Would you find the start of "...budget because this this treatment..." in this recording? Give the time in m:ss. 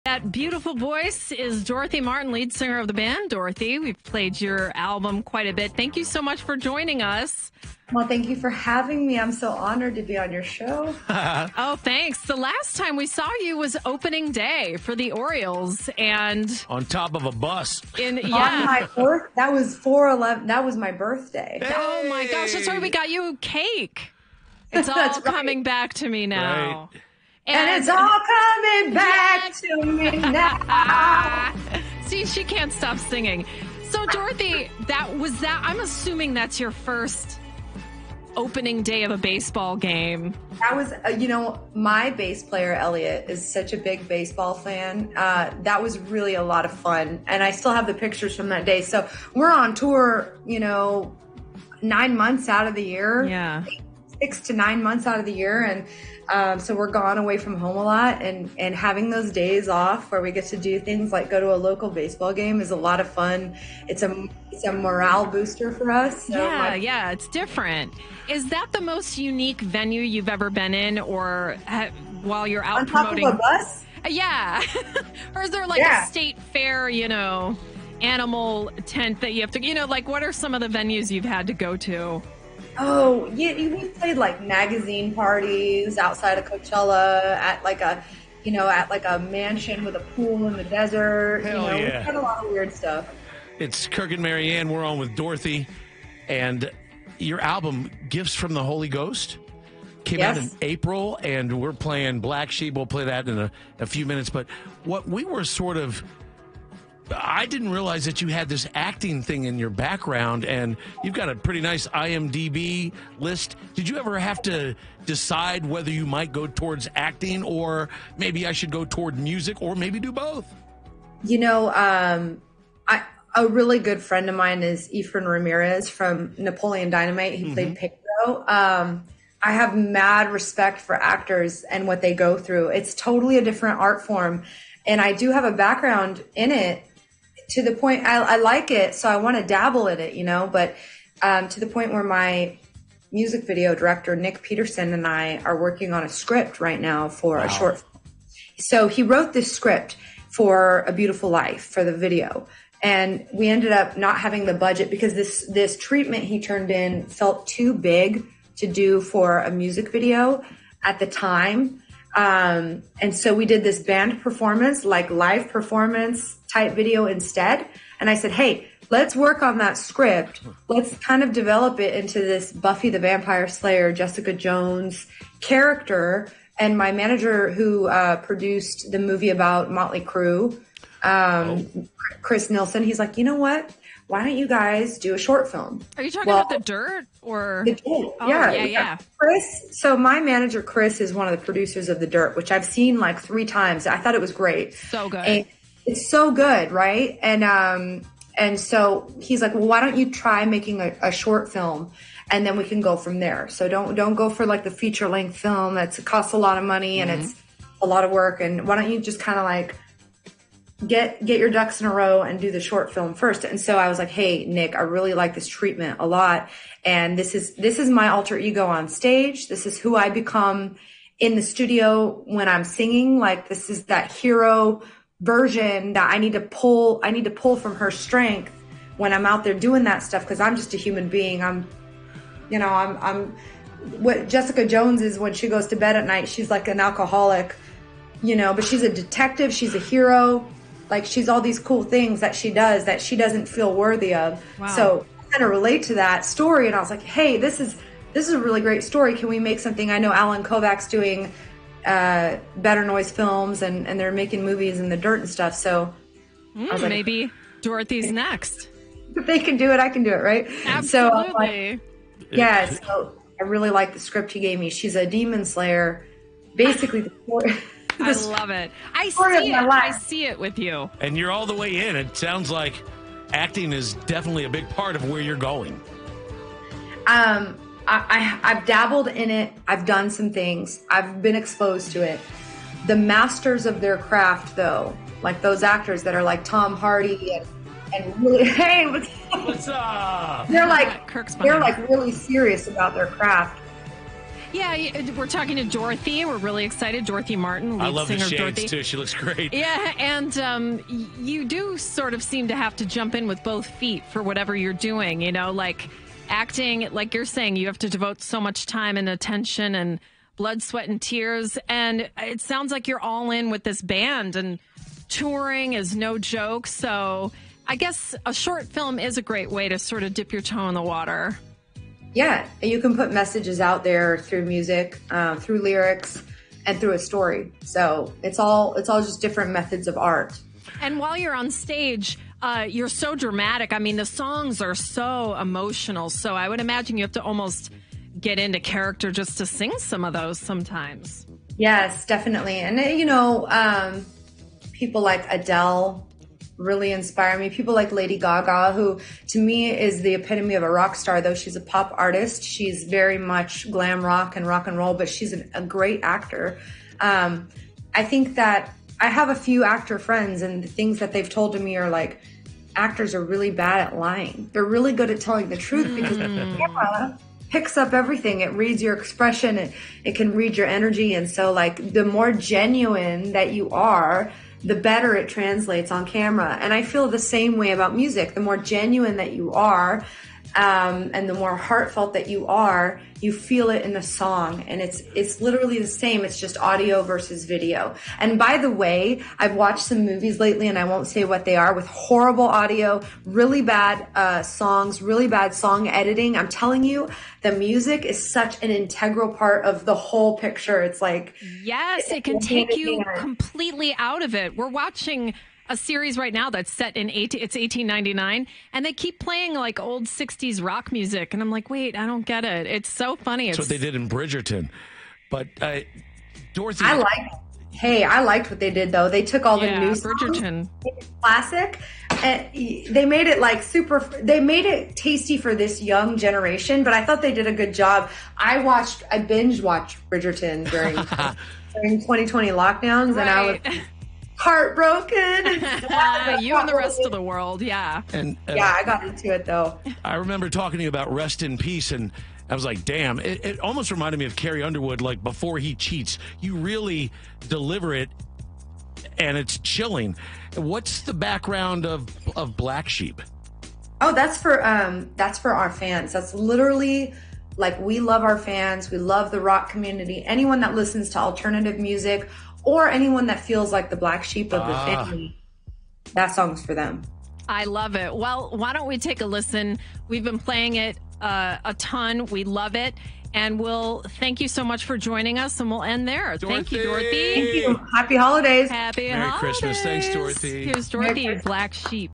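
2:34.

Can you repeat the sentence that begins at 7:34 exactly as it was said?
Oh, that's for um, that's for our fans.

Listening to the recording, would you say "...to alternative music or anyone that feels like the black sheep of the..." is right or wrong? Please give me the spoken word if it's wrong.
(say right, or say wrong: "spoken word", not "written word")
right.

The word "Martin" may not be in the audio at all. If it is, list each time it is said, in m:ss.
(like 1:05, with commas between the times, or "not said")
0:02, 4:57.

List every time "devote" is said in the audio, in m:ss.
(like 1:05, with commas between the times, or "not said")
5:07.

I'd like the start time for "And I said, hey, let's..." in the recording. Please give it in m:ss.
2:47.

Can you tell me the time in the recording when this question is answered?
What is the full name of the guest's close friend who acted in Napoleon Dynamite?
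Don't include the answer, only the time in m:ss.
2:04.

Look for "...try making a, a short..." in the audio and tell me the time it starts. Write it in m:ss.
3:20.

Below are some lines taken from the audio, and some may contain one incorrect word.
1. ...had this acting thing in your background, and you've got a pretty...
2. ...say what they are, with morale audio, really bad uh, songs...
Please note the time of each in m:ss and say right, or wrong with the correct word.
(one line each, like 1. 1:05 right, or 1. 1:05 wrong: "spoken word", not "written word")
1. 1:48 right
2. 6:31 wrong: "horrible", not "morale".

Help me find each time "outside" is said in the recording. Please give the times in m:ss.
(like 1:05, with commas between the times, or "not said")
1:25.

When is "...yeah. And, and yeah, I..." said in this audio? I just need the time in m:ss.
7:17.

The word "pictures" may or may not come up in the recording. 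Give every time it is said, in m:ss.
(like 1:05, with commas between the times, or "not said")
0:47, 6:40.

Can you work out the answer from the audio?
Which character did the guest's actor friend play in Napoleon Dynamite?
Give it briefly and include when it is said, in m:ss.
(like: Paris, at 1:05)
Pedro, at 2:07.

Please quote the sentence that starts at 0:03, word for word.
Dorothy, we've played your album quite a bit.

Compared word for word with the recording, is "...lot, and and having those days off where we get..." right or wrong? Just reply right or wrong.
right.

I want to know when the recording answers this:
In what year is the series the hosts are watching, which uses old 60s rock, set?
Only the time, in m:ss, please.
6:47.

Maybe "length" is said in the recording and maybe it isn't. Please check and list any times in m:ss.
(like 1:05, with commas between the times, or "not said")
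3:25.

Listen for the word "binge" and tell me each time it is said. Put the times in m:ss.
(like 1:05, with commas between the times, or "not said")
7:09.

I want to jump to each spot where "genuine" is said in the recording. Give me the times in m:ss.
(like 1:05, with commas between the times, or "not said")
6:12, 6:18.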